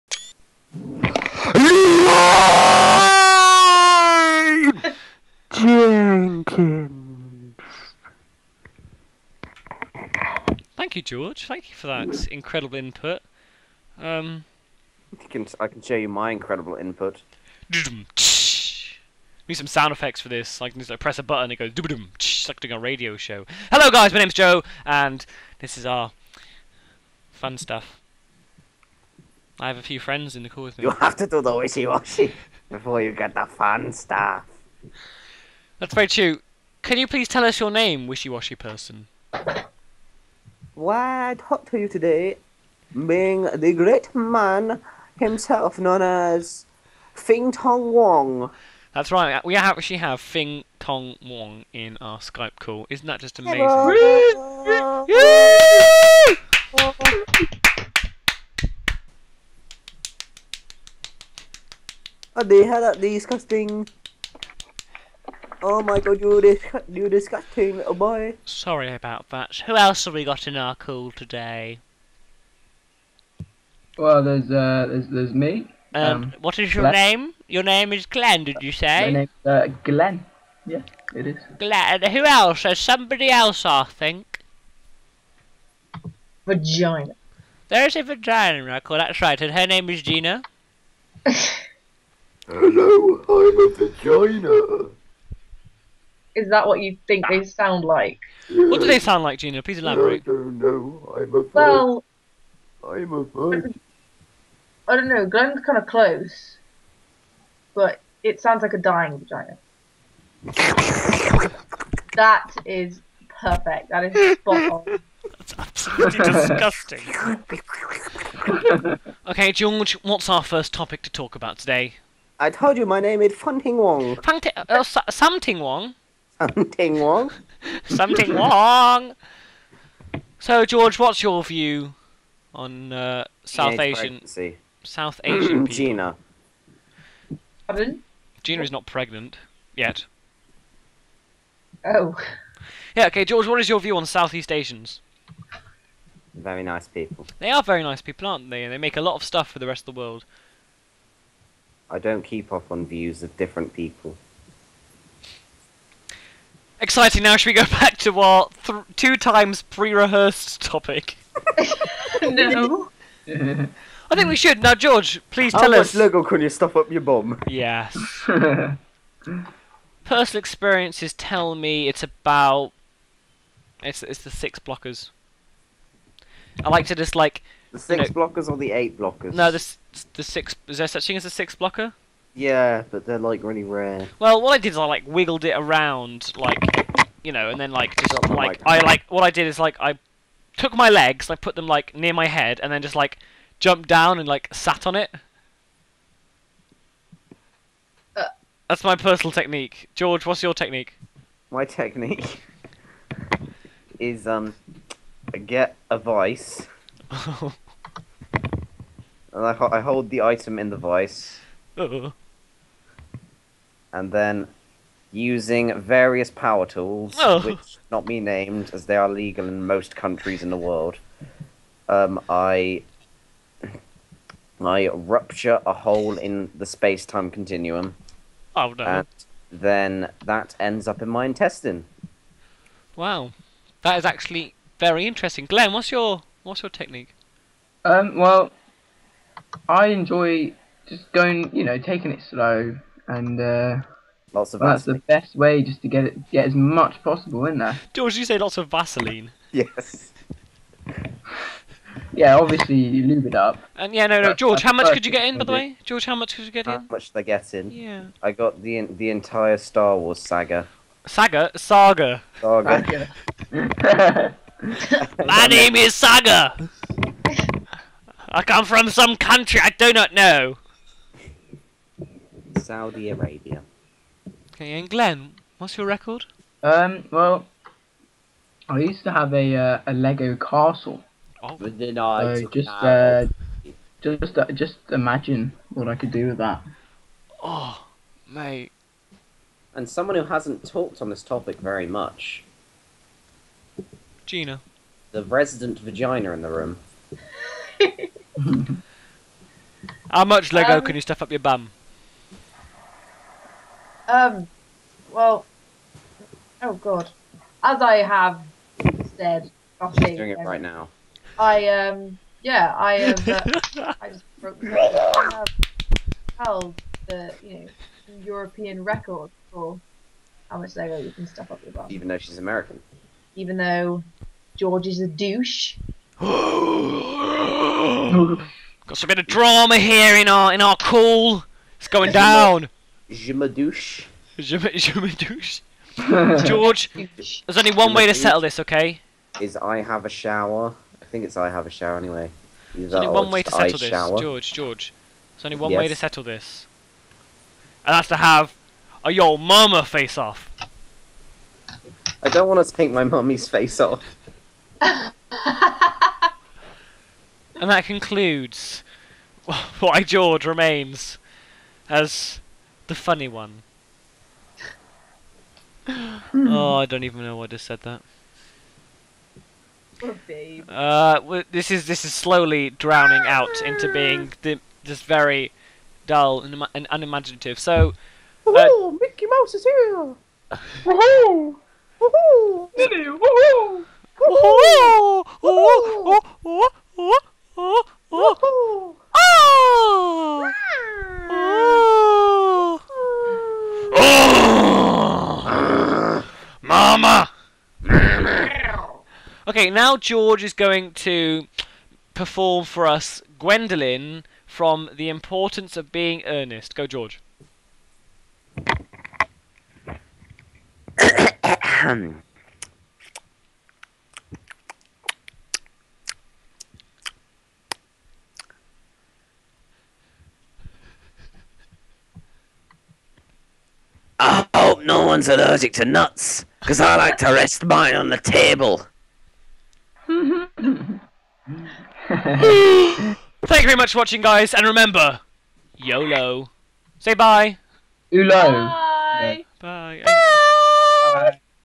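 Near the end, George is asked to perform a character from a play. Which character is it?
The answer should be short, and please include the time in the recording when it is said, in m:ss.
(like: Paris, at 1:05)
Gwendolyn, at 6:43.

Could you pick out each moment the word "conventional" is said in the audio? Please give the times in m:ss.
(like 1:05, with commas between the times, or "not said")
not said.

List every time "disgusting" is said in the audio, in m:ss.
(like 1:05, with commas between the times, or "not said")
1:03, 1:07, 1:56.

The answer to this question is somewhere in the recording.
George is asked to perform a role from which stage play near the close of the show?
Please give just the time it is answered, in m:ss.
6:44.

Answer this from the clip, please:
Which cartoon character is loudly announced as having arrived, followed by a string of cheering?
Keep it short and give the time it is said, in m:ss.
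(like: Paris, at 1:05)
Mickey Mouse, at 6:18.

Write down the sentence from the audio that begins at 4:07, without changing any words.
George, you say lots of Vaseline.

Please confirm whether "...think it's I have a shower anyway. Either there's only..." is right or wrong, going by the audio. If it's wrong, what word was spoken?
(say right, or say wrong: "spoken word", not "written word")
right.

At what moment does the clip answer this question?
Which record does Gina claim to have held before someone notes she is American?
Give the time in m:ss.
5:18.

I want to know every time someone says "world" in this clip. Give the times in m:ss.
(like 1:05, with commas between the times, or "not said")
2:29, 3:40.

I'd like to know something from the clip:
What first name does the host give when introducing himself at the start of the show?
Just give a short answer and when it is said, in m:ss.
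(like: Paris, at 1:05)
Joe, at 0:24.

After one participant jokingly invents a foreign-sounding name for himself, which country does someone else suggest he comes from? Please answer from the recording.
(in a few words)
Saudi Arabia.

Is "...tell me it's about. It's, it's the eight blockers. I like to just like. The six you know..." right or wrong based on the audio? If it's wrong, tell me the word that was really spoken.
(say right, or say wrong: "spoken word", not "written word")
wrong: "six", not "eight".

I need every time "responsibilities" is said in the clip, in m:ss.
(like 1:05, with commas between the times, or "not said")
not said.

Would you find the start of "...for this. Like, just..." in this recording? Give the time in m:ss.
0:20.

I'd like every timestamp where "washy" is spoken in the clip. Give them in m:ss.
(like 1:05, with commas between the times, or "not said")
0:31, 0:38.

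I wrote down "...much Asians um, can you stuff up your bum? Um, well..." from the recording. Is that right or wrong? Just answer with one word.
wrong.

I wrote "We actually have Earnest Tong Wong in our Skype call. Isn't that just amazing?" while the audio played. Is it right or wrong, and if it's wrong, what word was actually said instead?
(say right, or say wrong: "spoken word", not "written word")
wrong: "Fing", not "Earnest".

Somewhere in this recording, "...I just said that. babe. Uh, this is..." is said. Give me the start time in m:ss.
6:07.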